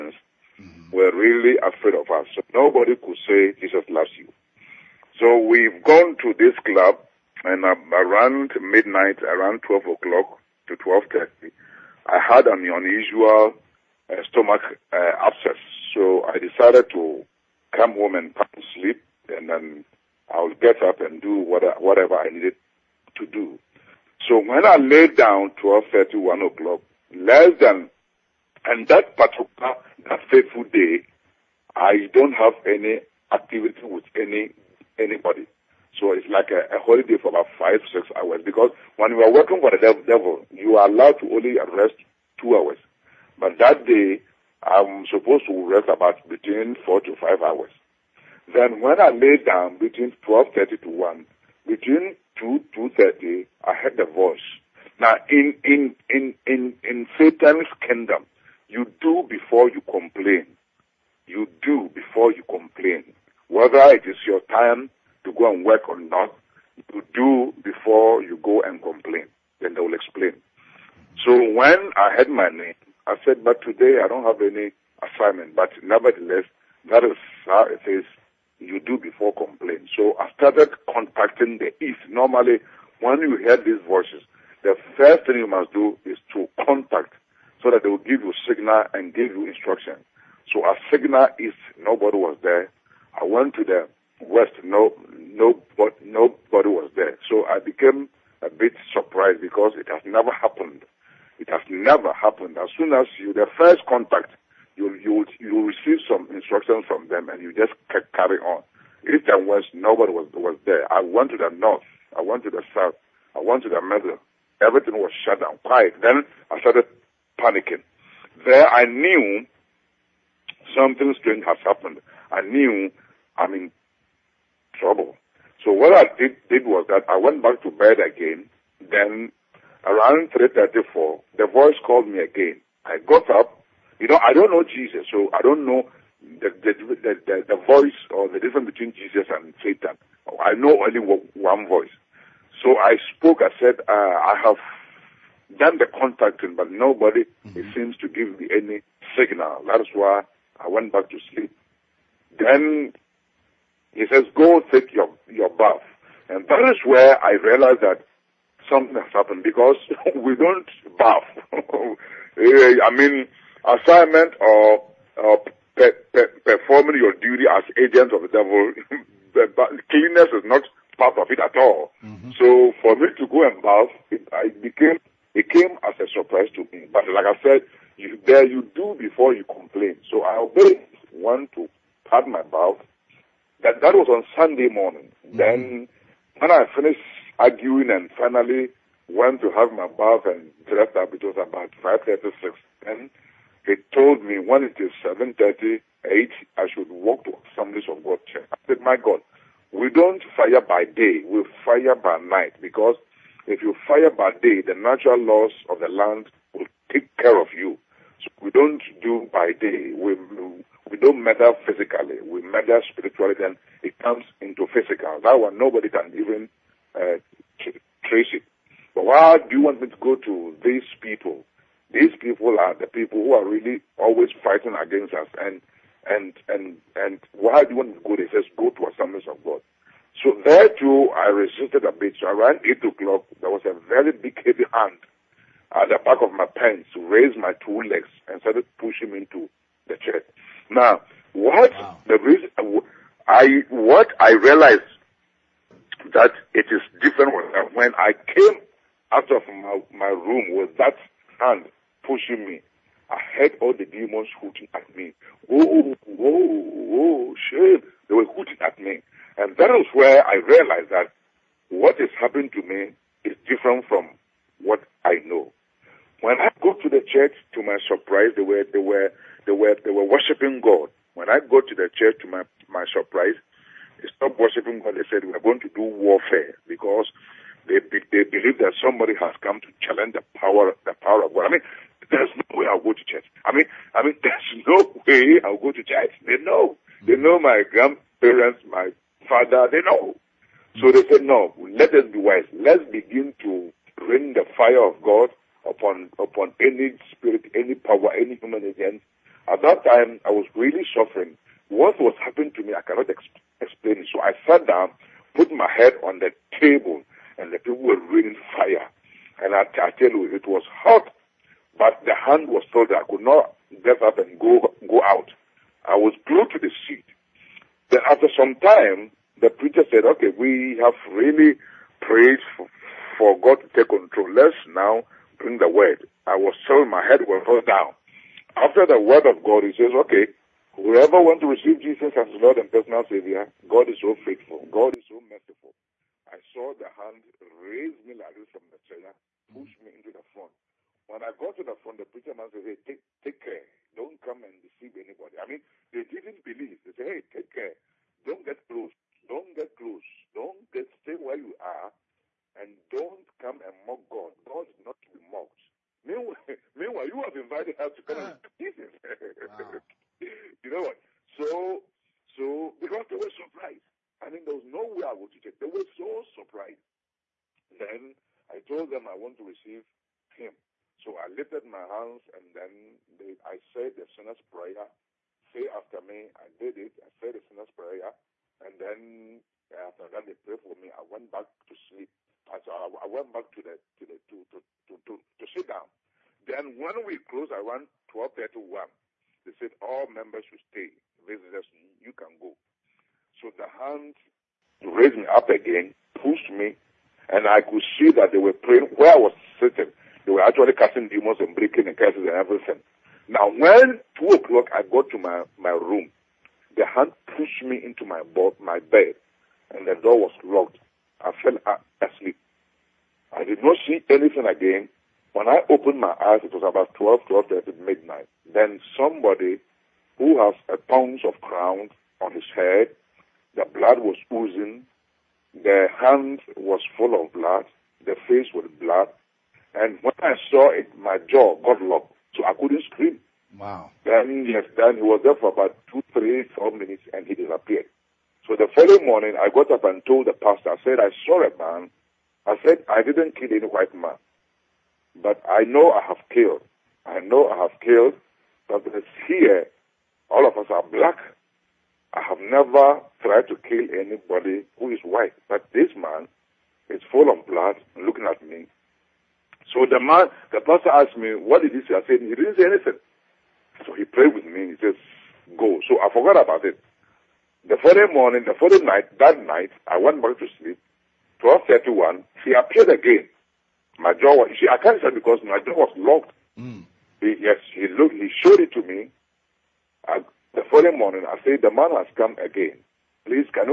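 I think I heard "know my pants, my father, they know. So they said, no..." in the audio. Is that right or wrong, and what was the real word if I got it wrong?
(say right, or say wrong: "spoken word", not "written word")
wrong: "grandparents", not "pants".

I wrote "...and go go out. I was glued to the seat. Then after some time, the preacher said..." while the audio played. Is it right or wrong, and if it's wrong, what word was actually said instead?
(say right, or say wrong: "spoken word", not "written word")
right.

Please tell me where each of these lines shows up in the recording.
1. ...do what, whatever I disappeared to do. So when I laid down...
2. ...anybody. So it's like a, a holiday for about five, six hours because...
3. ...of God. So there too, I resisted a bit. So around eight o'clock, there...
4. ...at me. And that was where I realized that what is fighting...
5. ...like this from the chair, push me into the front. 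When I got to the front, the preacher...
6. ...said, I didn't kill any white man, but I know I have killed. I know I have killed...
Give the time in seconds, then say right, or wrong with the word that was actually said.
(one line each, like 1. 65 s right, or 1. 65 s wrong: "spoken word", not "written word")
1. 21 s wrong: "needed", not "disappeared"
2. 34 s right
3. 229 s right
4. 258 s wrong: "happening", not "fighting"
5. 338 s right
6. 442 s right.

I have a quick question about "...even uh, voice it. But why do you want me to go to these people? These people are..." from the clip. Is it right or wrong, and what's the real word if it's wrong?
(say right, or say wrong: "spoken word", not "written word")
wrong: "trace", not "voice".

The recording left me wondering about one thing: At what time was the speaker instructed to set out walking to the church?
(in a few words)
7:38.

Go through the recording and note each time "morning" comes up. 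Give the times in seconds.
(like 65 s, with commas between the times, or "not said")
184 s, 439 s, 468 s, 480 s.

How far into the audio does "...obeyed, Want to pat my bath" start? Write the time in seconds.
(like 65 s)
180 s.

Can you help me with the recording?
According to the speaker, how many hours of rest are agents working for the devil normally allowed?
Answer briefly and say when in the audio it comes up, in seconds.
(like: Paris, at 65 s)
2 hours, at 42 s.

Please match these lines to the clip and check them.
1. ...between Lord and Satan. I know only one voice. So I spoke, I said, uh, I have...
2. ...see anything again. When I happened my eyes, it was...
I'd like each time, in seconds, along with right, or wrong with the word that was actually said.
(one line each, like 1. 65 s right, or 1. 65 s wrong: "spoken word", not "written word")
1. 138 s wrong: "Jesus", not "Lord"
2. 413 s wrong: "opened", not "happened".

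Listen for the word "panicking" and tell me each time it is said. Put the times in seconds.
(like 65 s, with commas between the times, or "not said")
117 s.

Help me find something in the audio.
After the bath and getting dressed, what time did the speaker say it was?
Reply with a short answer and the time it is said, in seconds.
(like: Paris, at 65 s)
5:36, at 191 s.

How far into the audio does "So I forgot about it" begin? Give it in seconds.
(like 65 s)
465 s.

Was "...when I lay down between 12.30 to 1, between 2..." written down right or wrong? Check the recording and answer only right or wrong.
right.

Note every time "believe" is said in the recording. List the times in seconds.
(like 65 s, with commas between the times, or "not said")
278 s, 346 s.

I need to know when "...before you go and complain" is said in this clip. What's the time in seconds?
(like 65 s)
67 s.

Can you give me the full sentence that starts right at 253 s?
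I heard all the demons hooting at me.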